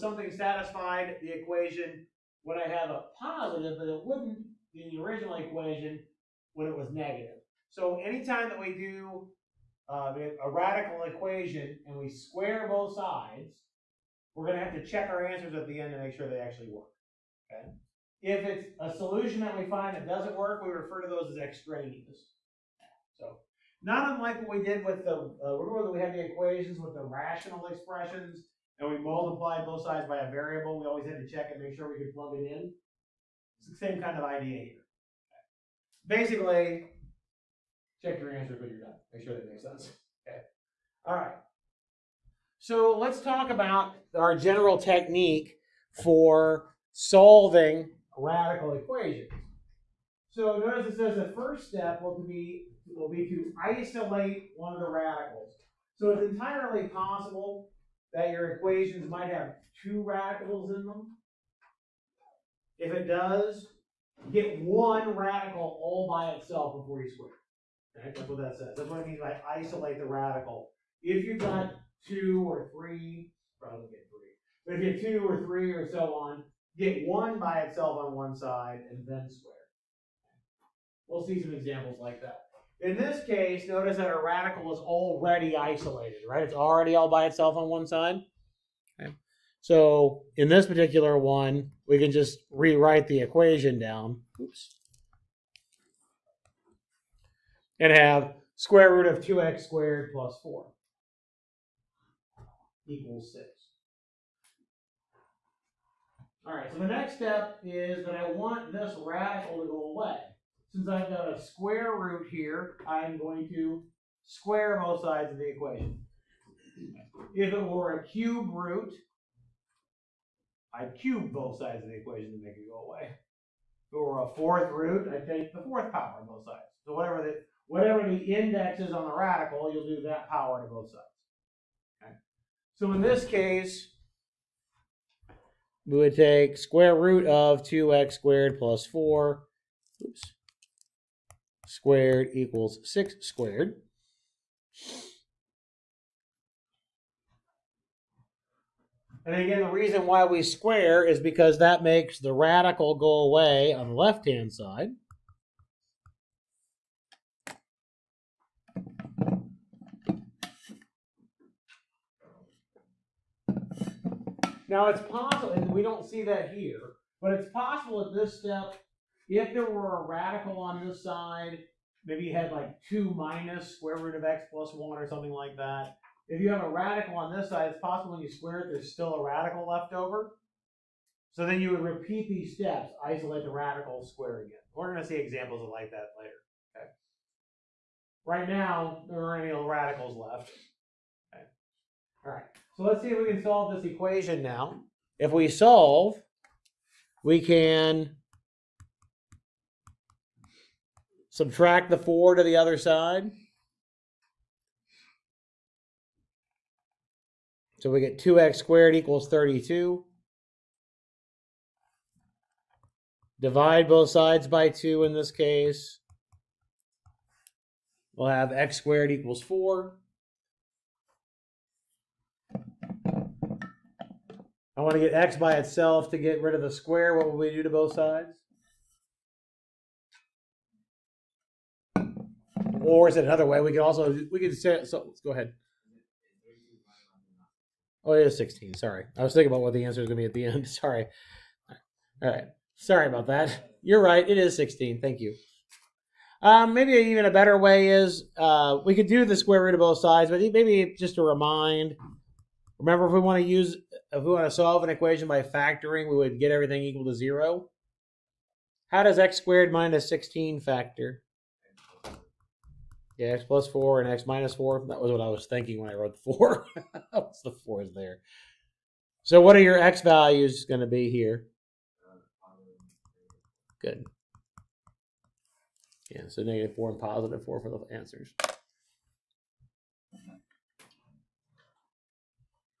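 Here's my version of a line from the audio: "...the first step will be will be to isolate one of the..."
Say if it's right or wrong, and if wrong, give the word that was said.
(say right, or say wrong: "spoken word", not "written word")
right.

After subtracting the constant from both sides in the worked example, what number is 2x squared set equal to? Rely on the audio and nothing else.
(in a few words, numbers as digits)
32.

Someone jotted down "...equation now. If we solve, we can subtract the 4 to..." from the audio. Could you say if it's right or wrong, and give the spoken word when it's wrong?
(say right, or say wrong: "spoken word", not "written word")
right.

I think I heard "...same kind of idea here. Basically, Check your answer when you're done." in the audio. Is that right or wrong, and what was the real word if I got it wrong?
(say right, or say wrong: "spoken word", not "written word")
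right.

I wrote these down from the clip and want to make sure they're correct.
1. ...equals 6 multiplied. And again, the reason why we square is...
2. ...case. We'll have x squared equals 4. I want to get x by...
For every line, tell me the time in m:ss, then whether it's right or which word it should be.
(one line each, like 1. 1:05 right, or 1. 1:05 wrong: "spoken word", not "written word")
1. 2:22 wrong: "squared", not "multiplied"
2. 3:35 right.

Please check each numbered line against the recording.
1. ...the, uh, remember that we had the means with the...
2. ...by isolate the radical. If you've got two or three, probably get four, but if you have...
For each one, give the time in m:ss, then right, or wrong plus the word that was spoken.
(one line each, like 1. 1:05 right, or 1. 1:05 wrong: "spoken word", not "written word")
1. 0:25 wrong: "equations", not "means"
2. 1:09 wrong: "three", not "four".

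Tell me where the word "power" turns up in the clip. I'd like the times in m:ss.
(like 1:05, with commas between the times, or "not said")
2:05, 2:10.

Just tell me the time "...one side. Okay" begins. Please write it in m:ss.
1:27.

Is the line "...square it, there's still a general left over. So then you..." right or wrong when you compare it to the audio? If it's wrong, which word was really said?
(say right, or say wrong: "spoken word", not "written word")
wrong: "radical", not "general".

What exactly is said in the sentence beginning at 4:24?
That was what I was thinking when I wrote 4.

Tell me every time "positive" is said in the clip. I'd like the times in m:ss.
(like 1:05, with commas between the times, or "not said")
0:03, 4:36.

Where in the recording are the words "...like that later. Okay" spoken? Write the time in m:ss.
3:05.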